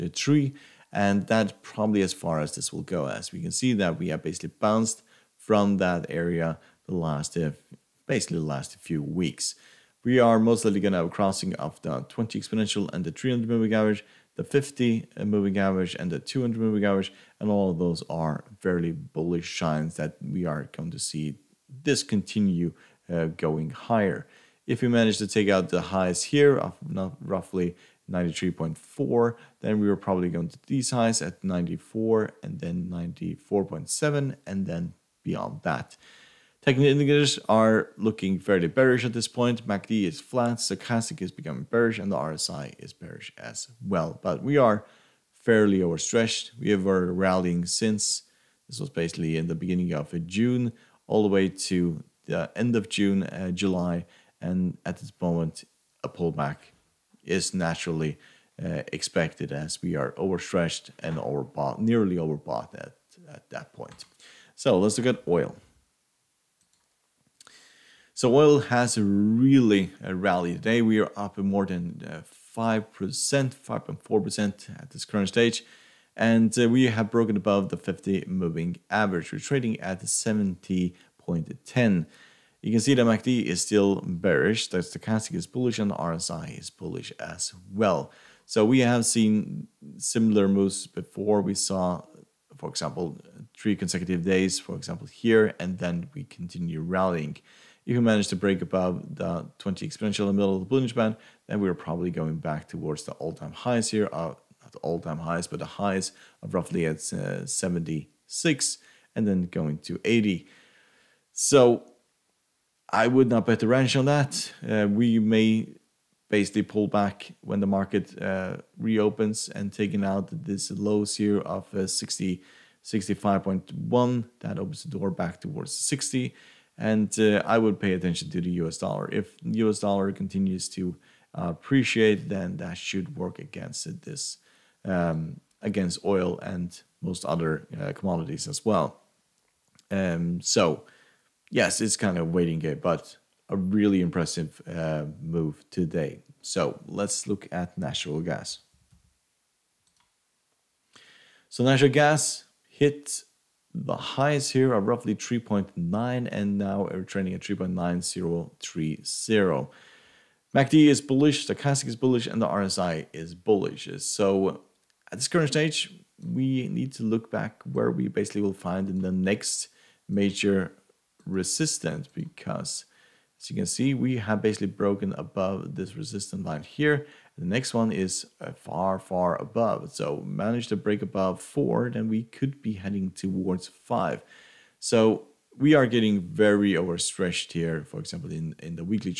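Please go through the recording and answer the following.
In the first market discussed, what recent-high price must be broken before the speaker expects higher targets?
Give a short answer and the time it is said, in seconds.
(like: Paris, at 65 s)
93.4, at 28 s.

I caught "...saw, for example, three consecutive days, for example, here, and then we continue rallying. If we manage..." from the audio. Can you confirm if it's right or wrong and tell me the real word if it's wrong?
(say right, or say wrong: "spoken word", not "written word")
right.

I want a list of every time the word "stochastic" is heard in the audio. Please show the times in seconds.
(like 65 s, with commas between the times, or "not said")
40 s, 84 s, 161 s.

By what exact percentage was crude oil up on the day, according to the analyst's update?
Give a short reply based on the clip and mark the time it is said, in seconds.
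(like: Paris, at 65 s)
5.4%, at 72 s.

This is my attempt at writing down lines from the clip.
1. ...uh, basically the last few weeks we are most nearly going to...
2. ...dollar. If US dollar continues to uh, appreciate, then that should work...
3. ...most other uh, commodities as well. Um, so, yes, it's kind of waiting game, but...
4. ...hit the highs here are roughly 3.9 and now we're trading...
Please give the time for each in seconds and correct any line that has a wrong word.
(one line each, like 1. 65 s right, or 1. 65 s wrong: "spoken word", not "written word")
1. 7 s wrong: "likely", not "nearly"
2. 128 s right
3. 137 s right
4. 152 s right.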